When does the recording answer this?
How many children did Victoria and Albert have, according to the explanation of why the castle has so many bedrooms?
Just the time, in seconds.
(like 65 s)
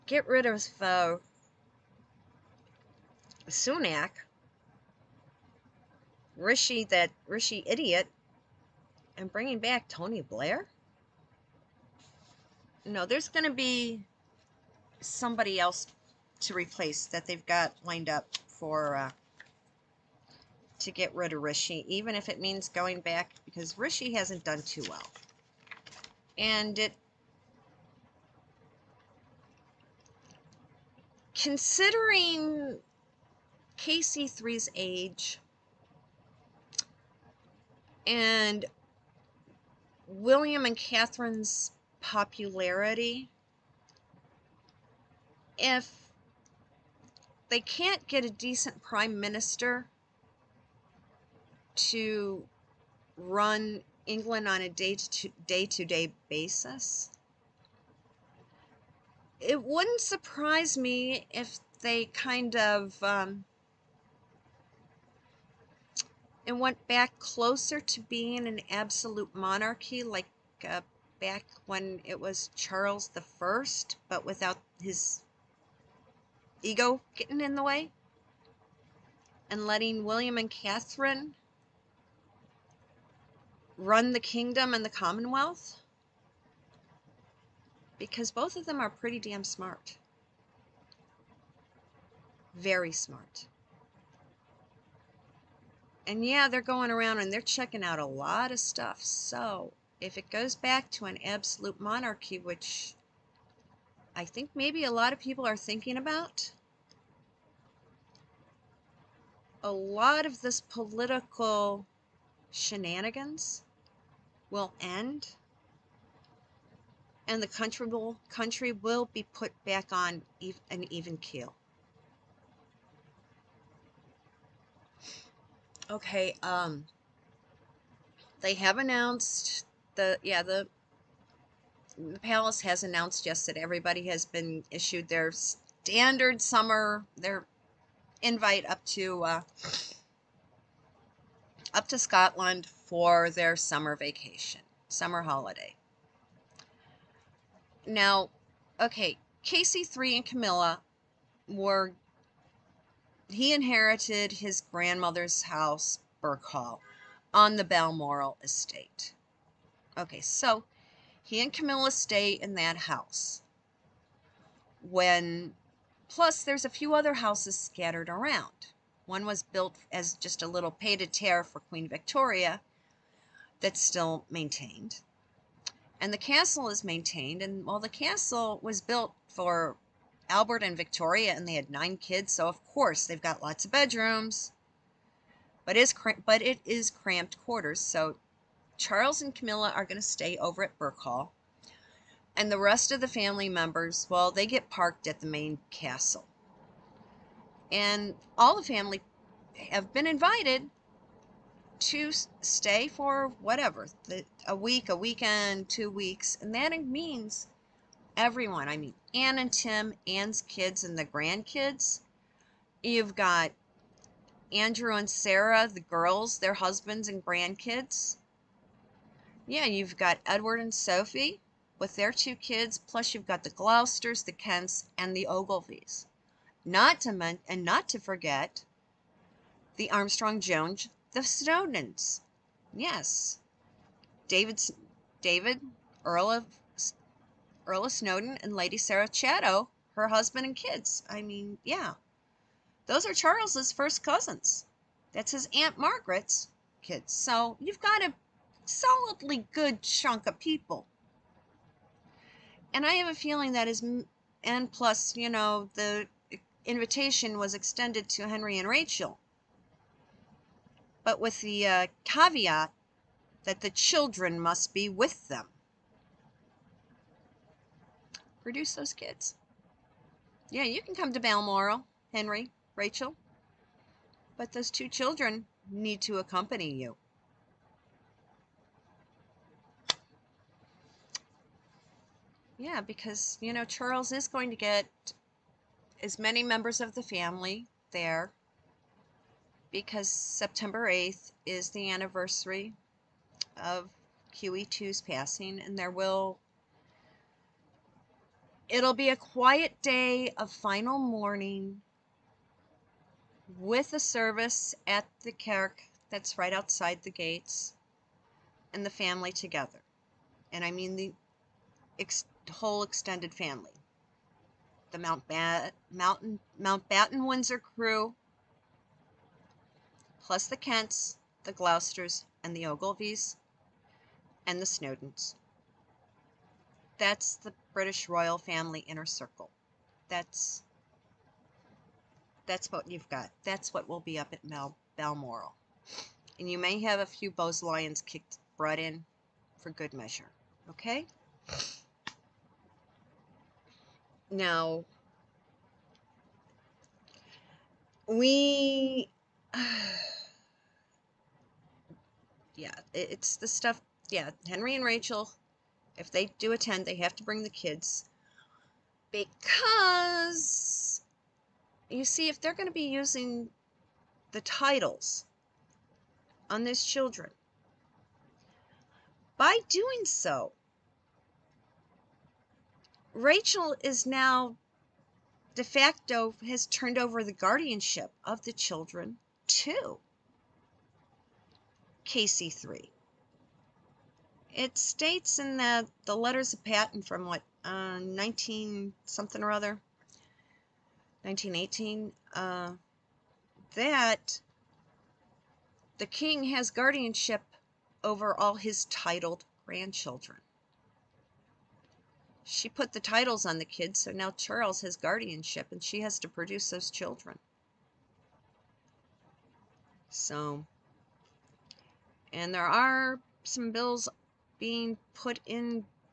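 181 s.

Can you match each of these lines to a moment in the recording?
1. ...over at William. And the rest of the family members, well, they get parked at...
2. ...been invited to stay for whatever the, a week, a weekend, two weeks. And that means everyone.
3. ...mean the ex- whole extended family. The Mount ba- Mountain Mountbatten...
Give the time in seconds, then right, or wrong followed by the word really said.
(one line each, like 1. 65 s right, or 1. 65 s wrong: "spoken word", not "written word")
1. 190 s wrong: "Birkhall", not "William"
2. 199 s right
3. 310 s right.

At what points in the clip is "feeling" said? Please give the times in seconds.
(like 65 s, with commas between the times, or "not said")
253 s.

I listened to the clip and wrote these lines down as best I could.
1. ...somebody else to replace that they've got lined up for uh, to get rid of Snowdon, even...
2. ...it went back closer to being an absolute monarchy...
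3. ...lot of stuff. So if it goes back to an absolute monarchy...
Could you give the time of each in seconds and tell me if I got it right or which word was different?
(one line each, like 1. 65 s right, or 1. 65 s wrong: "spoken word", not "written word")
1. 14 s wrong: "Rishi", not "Snowdon"
2. 66 s right
3. 98 s right.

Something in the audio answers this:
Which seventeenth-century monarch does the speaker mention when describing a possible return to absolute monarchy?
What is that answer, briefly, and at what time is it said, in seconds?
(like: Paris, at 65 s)
Charles the First, at 72 s.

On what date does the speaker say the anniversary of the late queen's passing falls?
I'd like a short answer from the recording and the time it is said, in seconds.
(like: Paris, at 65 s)
September 8th, at 290 s.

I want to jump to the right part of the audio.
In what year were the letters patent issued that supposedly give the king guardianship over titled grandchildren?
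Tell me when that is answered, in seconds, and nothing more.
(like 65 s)
391 s.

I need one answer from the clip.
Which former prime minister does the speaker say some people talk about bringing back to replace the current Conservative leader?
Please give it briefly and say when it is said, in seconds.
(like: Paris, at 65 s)
Tony Blair, at 9 s.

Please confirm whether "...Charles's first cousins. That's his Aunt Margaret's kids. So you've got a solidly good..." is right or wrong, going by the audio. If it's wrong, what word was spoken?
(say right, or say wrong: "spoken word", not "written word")
right.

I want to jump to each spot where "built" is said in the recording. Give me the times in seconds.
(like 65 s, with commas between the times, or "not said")
169 s, 178 s.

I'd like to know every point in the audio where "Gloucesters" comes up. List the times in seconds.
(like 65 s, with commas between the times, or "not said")
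223 s, 321 s.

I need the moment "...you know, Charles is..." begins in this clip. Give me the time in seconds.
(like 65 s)
283 s.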